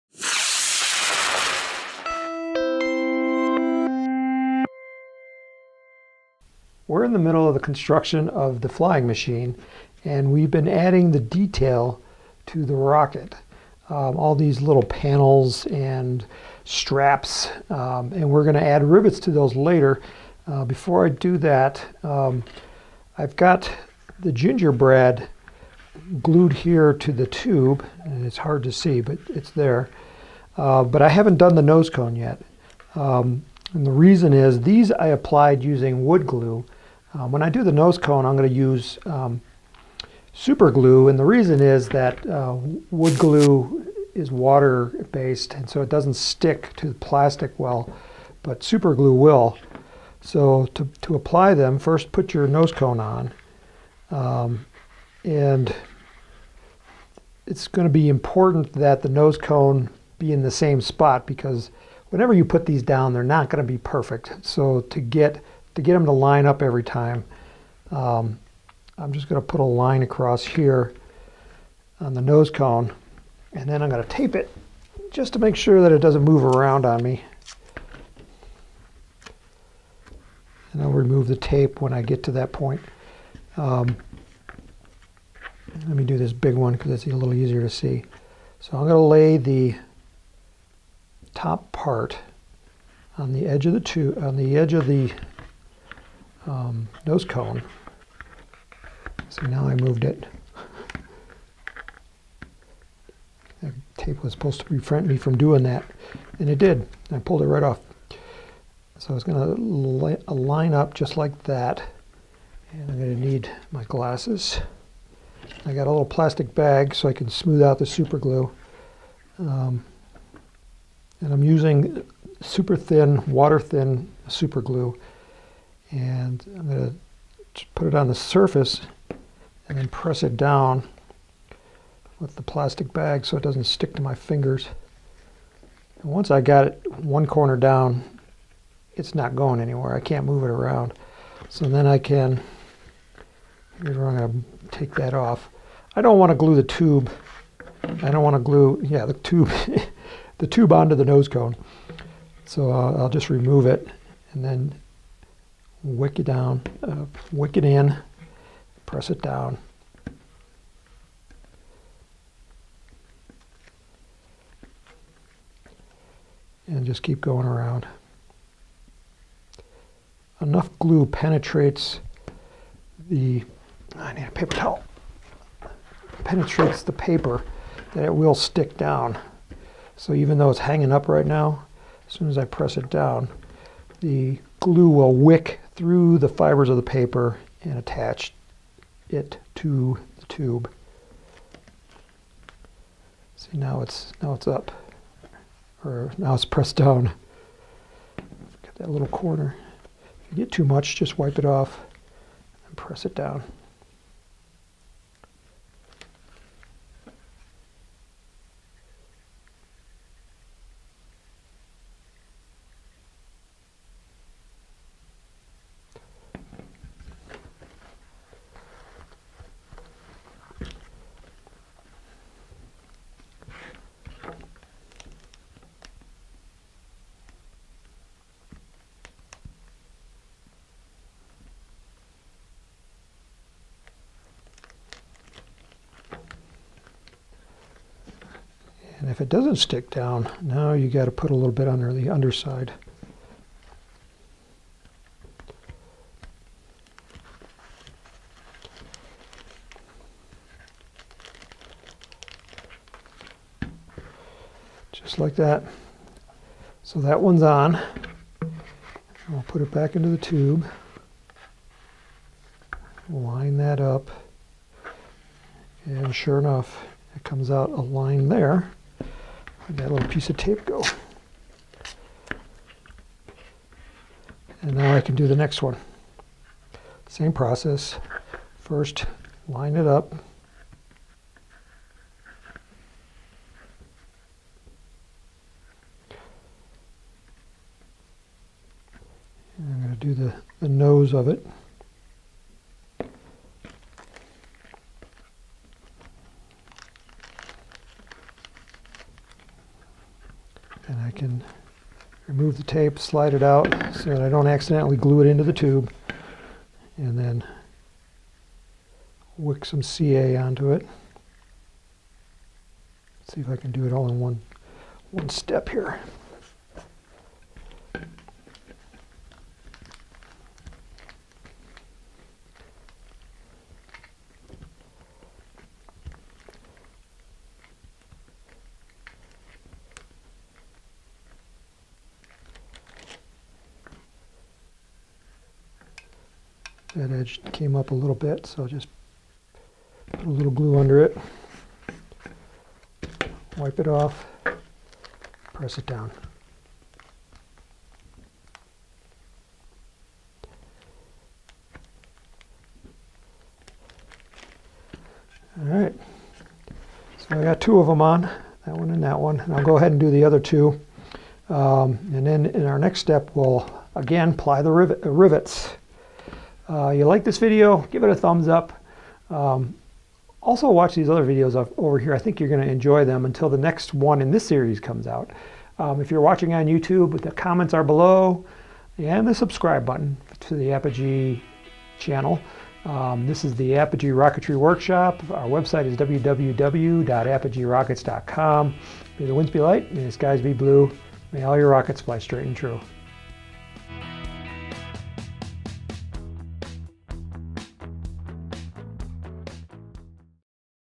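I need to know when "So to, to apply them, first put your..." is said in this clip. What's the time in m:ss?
0:50.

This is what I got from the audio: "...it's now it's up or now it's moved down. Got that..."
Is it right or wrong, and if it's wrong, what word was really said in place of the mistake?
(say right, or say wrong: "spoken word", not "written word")
wrong: "pressed", not "moved".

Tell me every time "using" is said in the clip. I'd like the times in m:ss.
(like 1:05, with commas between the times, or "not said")
0:35, 2:01.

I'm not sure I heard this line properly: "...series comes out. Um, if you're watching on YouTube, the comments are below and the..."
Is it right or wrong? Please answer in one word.
right.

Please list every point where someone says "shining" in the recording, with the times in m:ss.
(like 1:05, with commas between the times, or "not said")
not said.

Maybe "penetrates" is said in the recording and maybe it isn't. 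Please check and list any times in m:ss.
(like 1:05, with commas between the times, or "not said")
2:51, 2:56.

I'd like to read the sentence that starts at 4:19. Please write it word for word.
We'll put it back into the tube.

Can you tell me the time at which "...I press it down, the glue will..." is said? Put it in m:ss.
3:02.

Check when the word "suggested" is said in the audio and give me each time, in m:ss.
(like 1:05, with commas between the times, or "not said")
not said.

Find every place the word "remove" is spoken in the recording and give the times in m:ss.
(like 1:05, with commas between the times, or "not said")
1:20, 2:33, 5:02.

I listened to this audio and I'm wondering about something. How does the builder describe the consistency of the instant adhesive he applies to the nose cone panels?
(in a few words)
water thin.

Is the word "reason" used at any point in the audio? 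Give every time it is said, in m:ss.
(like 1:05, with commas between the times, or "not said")
0:33, 0:41.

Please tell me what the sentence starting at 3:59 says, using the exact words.
And if it doesn't stick down, now you got to put a little bit under the underside.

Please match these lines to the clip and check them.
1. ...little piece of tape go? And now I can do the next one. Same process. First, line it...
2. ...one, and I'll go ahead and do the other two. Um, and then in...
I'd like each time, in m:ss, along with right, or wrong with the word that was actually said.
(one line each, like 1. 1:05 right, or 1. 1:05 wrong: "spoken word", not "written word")
1. 4:29 right
2. 5:59 right.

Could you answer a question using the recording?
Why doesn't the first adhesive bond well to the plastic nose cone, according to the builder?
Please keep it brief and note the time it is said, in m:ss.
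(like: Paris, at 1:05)
water-based, at 0:44.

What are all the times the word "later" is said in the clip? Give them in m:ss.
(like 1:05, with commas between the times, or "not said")
0:19.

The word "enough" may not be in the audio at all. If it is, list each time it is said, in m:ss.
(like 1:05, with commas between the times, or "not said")
2:50, 4:26.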